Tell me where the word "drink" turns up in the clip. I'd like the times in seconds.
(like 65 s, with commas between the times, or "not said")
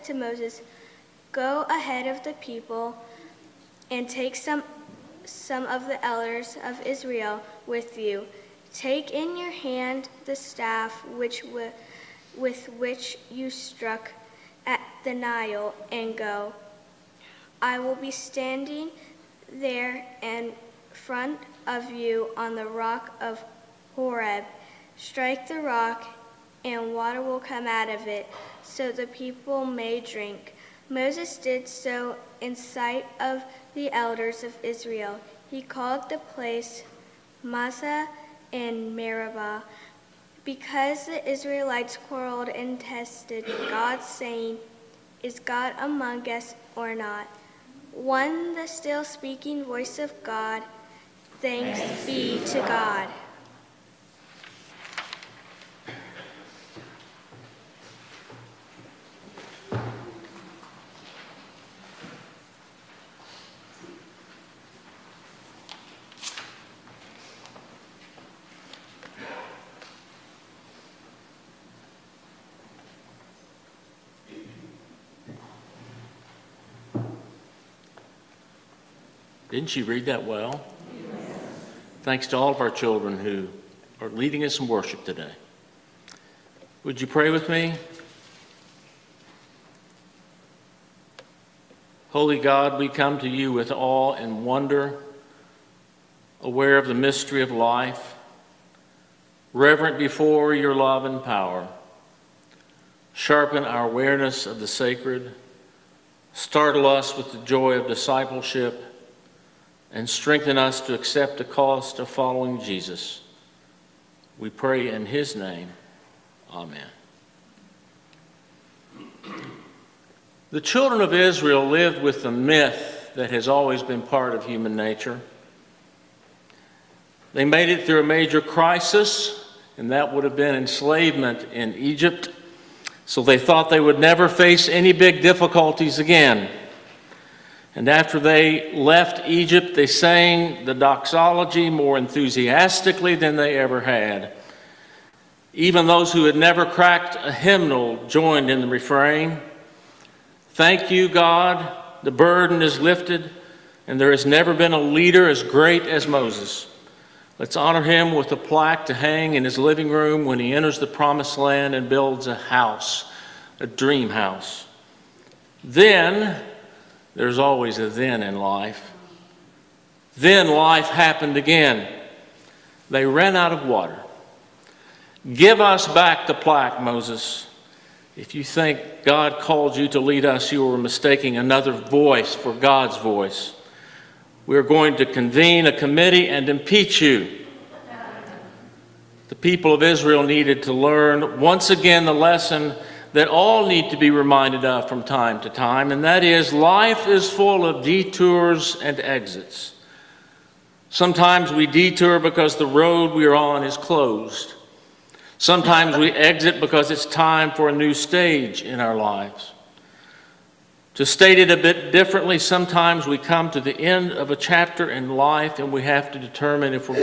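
30 s.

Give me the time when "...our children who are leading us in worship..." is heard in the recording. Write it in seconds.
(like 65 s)
82 s.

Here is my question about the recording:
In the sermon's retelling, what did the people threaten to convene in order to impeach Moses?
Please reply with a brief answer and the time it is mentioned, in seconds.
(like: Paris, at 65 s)
A committee, at 185 s.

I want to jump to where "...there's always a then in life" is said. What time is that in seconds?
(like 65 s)
167 s.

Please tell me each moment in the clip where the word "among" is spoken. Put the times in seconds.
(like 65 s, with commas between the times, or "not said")
45 s.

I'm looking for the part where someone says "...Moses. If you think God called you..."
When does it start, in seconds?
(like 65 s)
176 s.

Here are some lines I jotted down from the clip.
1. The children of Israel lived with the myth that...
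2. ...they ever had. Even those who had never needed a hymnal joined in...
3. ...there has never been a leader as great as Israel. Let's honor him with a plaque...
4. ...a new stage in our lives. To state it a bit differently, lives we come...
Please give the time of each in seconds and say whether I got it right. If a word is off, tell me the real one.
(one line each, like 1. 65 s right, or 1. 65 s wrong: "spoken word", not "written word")
1. 120 s right
2. 143 s wrong: "cracked", not "needed"
3. 154 s wrong: "Moses", not "Israel"
4. 207 s wrong: "sometimes", not "lives".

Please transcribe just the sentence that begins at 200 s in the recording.
Sometimes we detour because the road we are on is closed.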